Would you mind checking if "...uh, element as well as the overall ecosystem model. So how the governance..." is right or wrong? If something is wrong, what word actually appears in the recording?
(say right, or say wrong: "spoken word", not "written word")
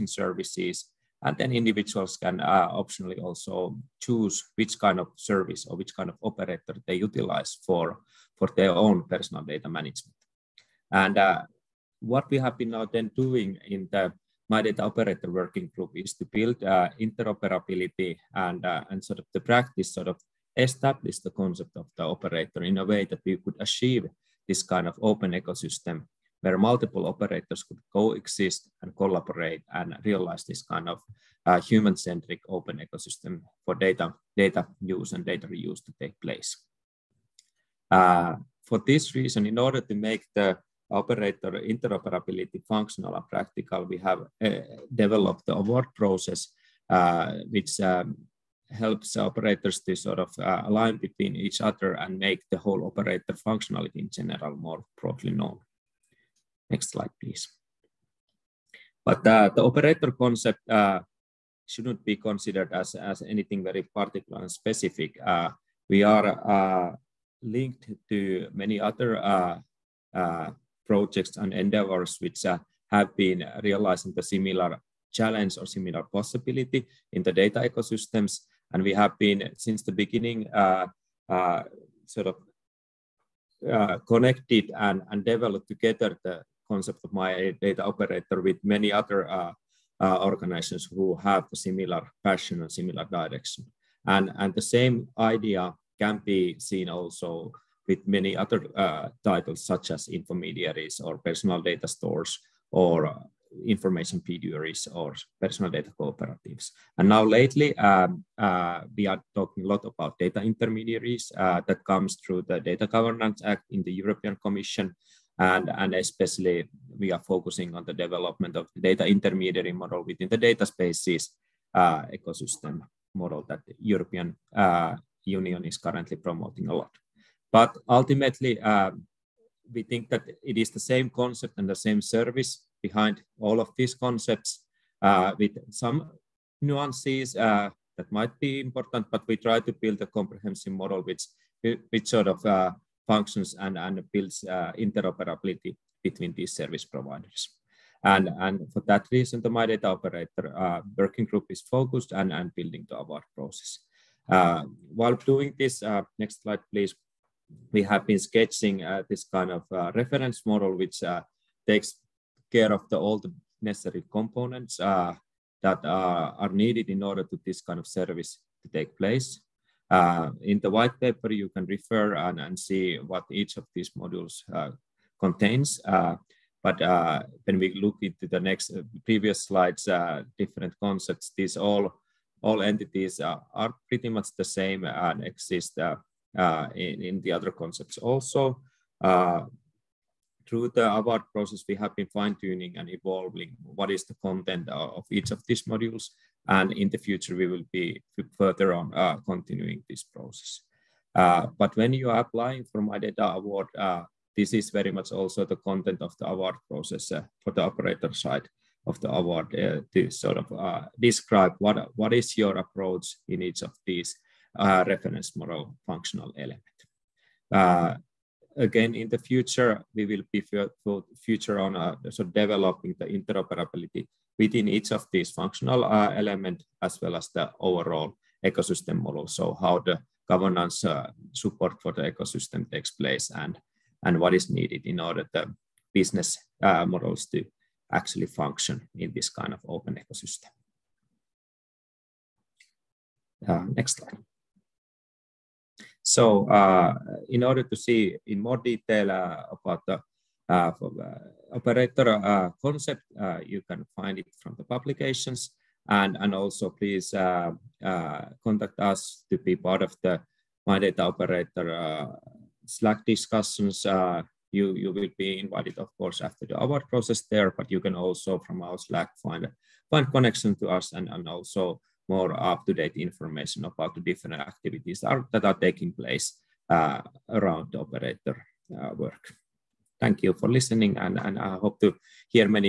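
right.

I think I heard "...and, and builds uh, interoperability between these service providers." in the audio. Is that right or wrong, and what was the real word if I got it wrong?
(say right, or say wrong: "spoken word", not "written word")
right.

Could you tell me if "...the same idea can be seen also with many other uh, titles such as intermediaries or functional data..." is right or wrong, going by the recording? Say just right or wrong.
wrong.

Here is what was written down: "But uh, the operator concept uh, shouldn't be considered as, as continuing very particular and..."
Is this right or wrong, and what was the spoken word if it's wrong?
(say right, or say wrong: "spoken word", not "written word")
wrong: "anything", not "continuing".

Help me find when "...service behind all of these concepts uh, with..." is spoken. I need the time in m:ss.
2:12.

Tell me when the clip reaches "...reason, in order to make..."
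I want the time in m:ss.
0:39.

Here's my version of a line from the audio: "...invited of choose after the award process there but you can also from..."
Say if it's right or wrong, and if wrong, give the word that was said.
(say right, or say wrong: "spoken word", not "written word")
wrong: "course", not "choose".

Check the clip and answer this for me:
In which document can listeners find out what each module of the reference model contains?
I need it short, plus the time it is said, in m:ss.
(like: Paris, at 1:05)
white paper, at 2:50.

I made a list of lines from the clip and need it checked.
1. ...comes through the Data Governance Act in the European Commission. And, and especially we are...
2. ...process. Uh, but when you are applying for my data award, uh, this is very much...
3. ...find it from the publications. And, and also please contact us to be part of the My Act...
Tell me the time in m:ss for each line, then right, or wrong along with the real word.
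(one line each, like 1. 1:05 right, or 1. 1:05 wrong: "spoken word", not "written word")
1. 1:51 right
2. 3:20 right
3. 4:13 wrong: "Data", not "Act".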